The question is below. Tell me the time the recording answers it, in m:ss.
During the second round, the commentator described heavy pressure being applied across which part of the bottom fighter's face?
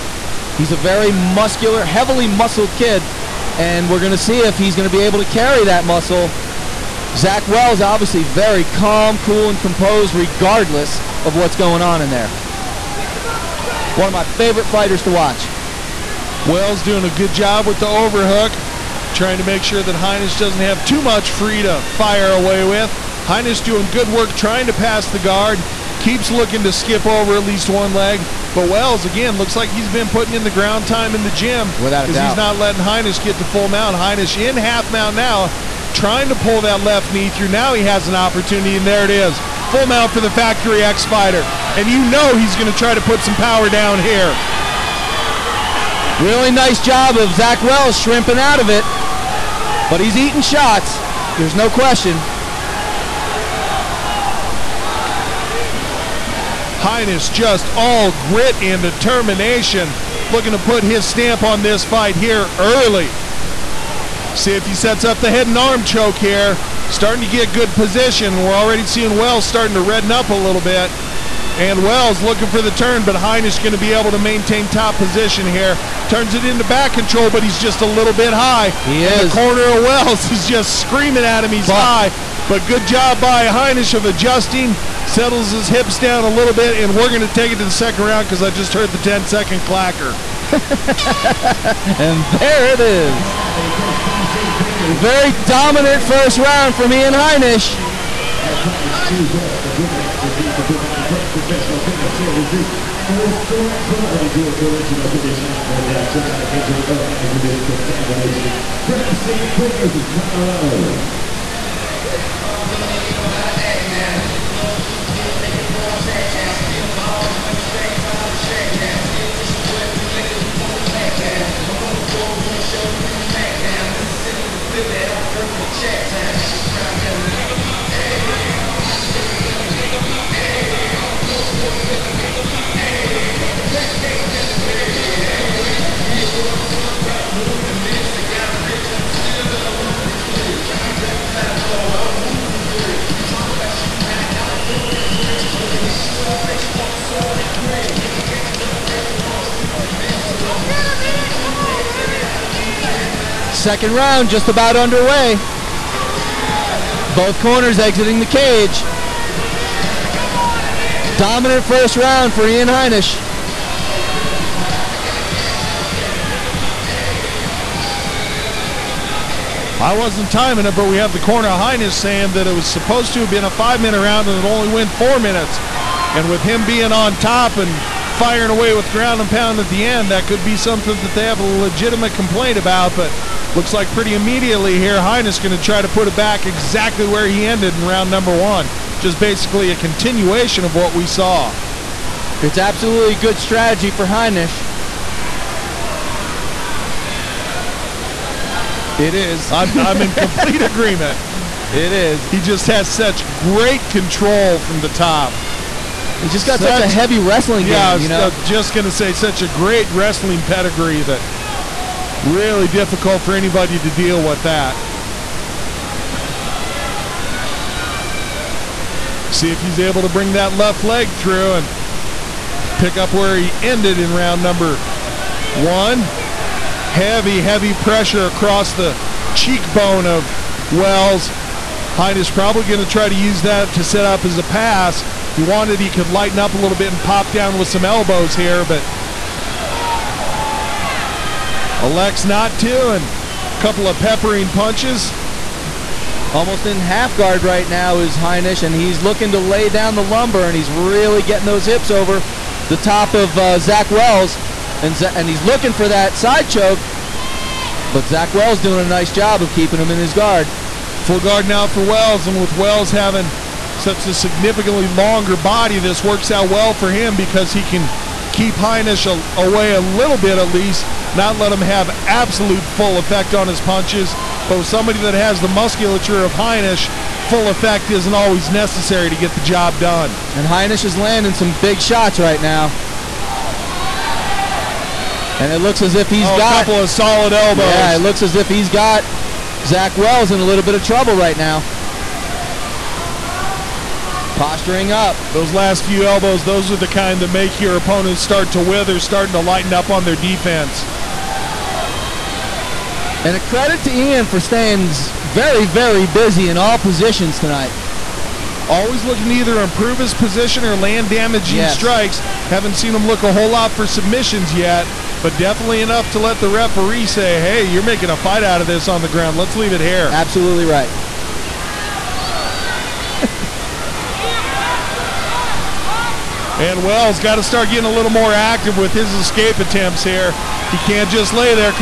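3:49.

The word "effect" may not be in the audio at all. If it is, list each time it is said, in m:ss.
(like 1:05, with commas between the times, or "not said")
4:32, 4:37.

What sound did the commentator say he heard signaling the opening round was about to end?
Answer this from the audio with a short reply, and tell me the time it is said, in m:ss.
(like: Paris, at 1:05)
10 second clacker, at 1:28.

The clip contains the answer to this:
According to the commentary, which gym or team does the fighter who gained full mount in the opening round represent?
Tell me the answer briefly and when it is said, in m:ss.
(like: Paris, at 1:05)
Factory X, at 0:40.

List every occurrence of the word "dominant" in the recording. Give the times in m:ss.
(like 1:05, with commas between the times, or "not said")
1:35, 2:41.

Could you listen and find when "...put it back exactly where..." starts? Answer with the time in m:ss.
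3:05.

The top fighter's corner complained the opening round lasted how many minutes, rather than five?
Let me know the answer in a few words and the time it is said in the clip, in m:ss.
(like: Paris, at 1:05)
4, at 2:54.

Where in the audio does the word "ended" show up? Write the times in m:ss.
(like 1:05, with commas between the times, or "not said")
3:07, 3:43.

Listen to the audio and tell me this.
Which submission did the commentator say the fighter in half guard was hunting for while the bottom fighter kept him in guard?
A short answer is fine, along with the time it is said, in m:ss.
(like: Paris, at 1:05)
Side choke, at 4:16.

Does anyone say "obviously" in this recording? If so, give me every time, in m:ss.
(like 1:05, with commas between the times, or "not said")
0:07.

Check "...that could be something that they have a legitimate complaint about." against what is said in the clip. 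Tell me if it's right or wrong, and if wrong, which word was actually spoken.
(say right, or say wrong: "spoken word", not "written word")
right.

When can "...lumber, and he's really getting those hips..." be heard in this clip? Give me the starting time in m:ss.
4:10.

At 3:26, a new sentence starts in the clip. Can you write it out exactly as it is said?
He's just got such, such a heavy wrestling game, yeah, you know.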